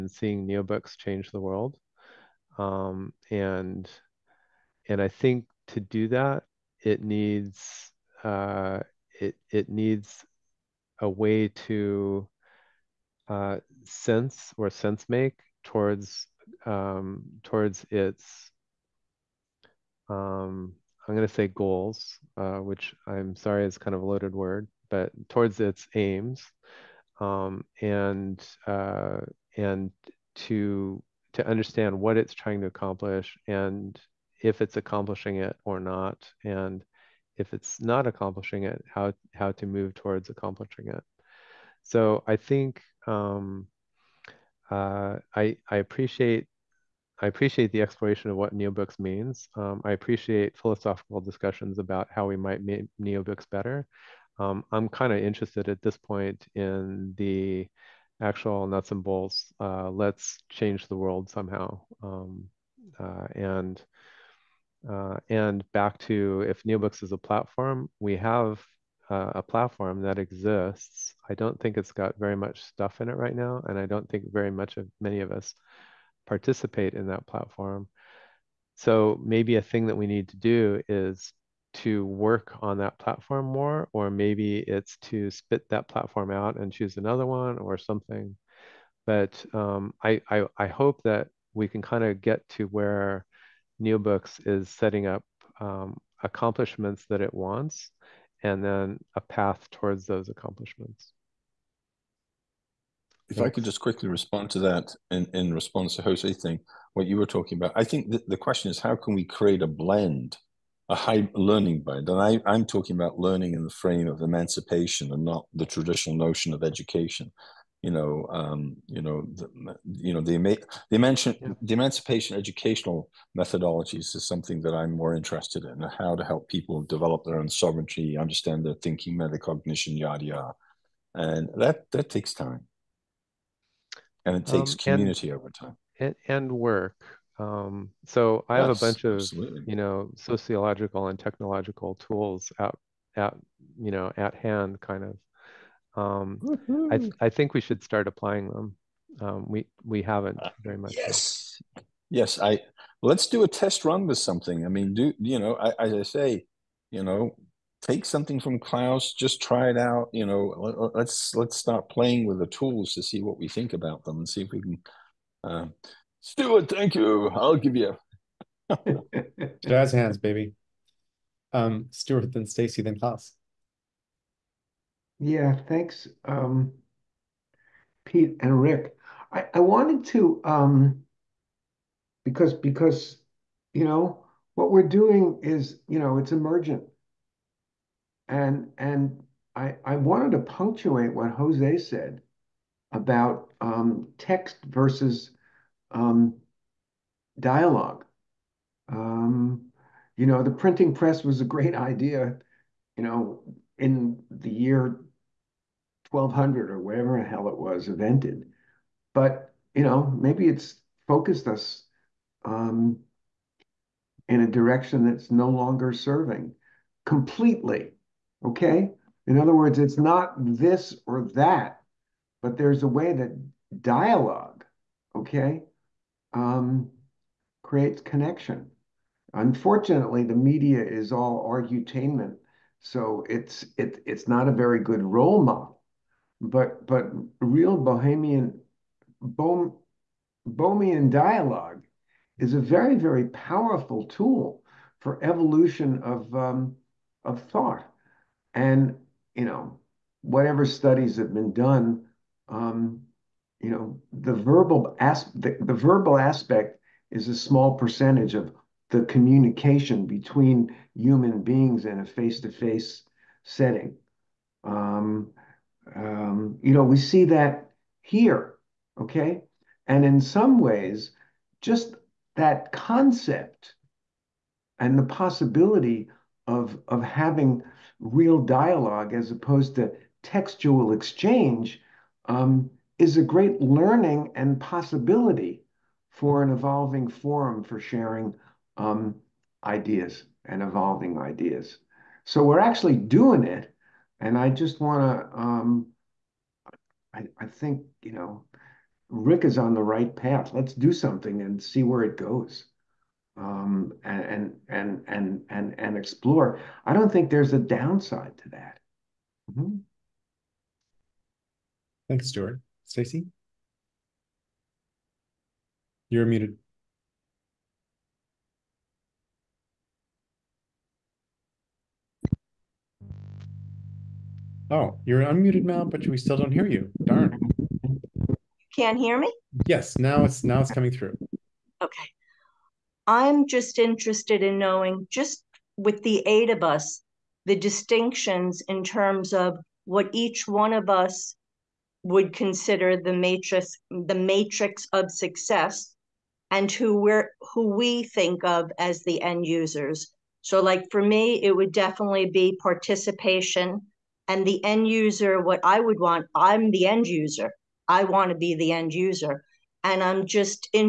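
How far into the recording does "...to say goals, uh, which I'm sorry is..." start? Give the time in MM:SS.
00:21.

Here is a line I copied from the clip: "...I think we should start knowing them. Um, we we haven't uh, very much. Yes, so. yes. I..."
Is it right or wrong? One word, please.
wrong.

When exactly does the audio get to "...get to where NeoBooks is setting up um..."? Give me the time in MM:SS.
01:32.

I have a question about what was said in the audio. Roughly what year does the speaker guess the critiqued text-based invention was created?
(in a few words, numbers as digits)
1200.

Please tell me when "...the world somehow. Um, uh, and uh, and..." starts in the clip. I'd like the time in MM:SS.
01:00.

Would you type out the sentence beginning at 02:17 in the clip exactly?
Um, so I yes, have a bunch of absolutely.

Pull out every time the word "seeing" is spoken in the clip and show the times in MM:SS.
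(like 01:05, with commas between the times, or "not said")
00:00.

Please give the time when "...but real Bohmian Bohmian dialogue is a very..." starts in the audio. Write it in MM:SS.
03:56.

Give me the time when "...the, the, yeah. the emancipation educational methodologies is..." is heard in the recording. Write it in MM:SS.
02:00.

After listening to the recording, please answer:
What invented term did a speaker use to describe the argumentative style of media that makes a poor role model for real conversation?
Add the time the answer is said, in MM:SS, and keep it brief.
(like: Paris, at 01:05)
argutainment, at 03:51.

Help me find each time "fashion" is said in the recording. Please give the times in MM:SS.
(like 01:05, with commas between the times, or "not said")
not said.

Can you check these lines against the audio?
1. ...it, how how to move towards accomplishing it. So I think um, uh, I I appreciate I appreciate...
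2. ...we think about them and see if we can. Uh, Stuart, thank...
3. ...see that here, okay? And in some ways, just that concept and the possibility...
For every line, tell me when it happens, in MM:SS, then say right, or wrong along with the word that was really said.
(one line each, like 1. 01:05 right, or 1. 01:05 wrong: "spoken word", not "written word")
1. 00:38 right
2. 02:43 right
3. 04:26 right.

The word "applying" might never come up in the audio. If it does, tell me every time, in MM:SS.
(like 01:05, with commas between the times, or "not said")
02:28.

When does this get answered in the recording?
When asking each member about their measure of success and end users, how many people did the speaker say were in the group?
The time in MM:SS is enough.
05:36.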